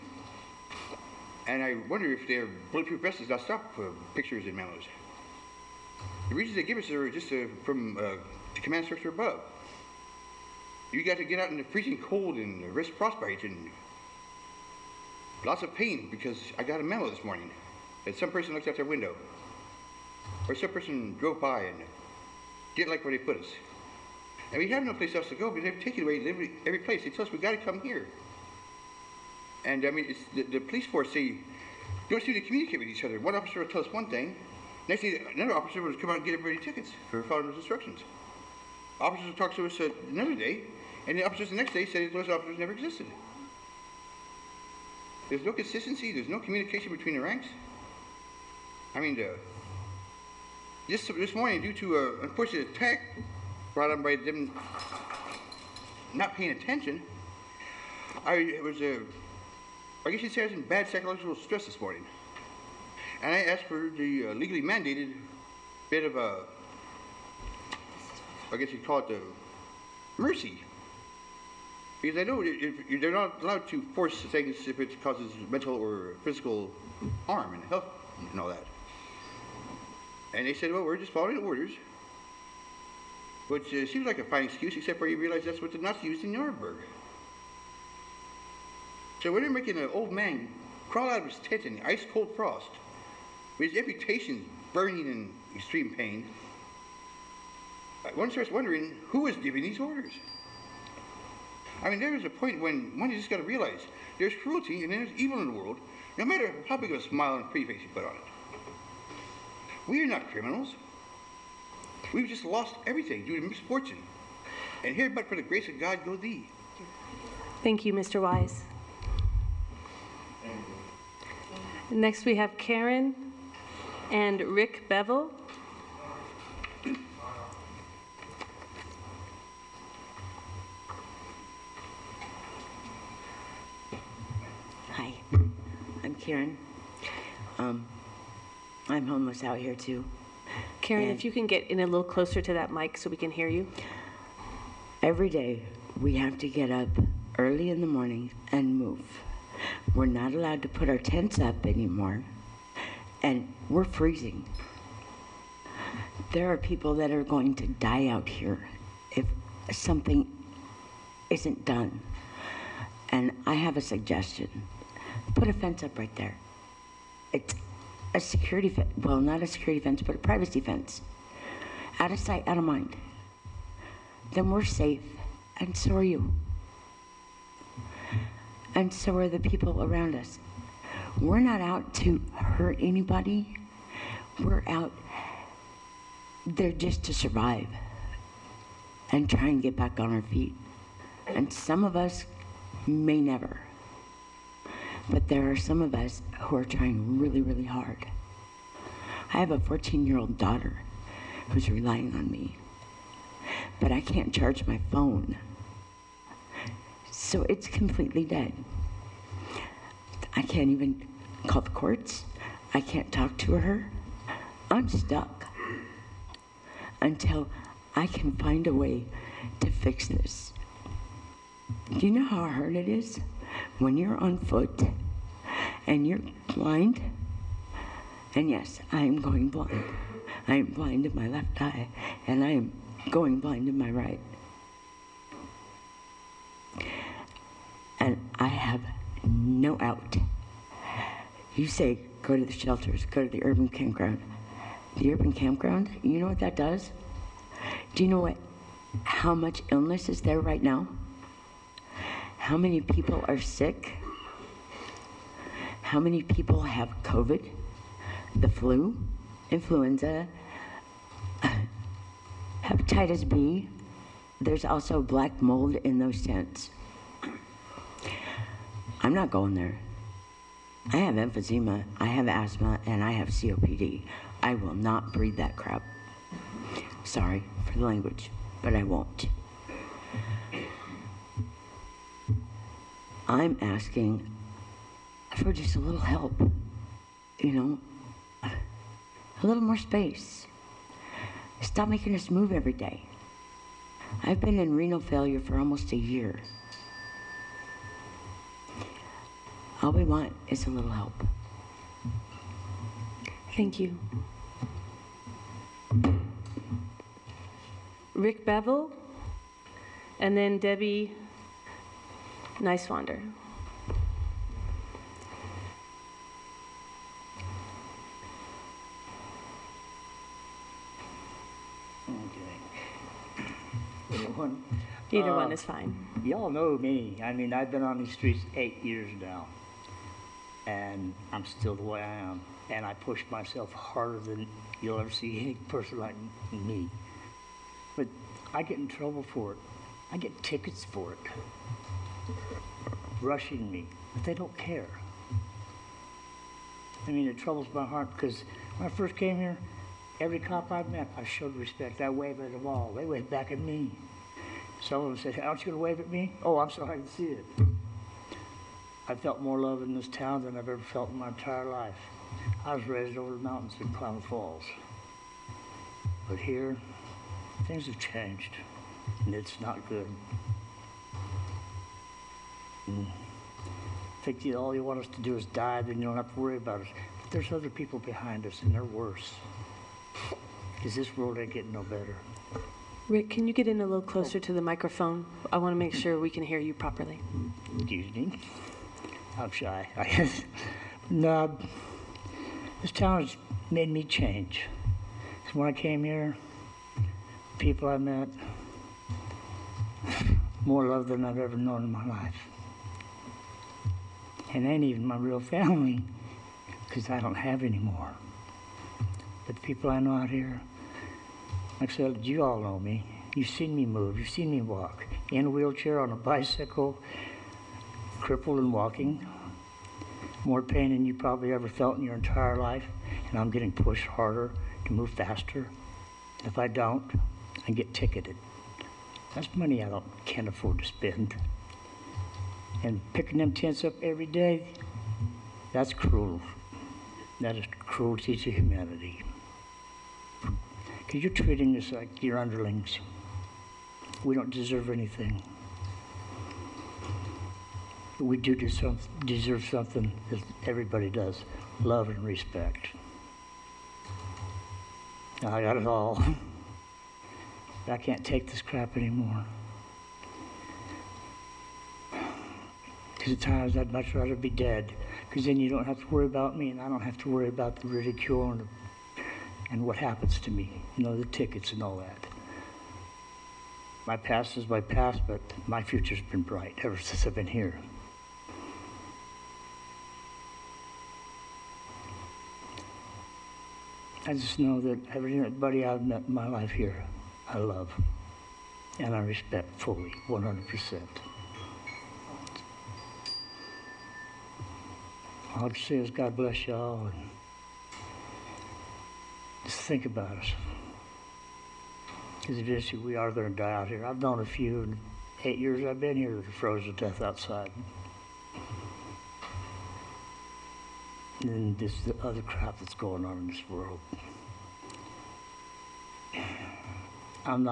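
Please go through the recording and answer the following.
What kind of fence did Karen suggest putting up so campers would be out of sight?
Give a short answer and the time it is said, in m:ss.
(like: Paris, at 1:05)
A privacy fence, at 2:50.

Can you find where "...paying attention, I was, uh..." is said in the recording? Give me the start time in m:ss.
0:56.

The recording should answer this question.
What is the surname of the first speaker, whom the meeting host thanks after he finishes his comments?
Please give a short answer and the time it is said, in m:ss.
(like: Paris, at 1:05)
Wise, at 1:57.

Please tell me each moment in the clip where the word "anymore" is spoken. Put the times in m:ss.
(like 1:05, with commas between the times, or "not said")
2:31, 7:38.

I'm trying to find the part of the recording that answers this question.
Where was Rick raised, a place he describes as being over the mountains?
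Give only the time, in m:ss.
6:03.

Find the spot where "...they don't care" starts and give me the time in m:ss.
5:44.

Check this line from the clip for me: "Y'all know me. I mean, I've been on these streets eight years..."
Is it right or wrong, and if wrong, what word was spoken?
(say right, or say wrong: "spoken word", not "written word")
right.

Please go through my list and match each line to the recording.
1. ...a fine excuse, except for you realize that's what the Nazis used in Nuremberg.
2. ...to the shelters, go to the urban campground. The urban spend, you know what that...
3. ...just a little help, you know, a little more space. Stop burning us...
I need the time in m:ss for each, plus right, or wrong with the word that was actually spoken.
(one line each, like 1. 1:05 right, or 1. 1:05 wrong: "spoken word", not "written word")
1. 1:24 right
2. 4:02 wrong: "campground", not "spend"
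3. 4:45 wrong: "making", not "burning".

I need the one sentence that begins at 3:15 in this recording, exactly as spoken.
But there are some of us who are trying really, really hard.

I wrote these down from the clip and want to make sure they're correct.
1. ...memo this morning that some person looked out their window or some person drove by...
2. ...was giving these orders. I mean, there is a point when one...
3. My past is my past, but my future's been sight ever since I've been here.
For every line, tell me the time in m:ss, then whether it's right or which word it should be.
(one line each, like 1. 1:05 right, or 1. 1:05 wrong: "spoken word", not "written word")
1. 0:16 right
2. 1:39 right
3. 7:54 wrong: "bright", not "sight".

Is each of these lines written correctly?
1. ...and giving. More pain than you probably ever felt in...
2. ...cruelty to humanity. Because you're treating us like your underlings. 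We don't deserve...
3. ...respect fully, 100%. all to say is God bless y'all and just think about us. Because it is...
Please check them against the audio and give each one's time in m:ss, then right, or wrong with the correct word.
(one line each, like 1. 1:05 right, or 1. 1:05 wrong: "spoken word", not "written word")
1. 6:58 wrong: "walking", not "giving"
2. 7:17 right
3. 8:09 right.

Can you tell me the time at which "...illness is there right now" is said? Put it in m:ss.
4:09.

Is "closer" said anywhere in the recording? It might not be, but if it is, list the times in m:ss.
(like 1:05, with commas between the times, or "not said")
2:22, 6:24.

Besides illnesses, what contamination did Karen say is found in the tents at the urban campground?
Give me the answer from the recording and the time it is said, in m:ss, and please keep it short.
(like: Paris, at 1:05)
Black mold, at 4:25.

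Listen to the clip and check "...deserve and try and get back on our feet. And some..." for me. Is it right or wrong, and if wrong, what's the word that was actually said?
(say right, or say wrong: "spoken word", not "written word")
wrong: "survive", not "deserve".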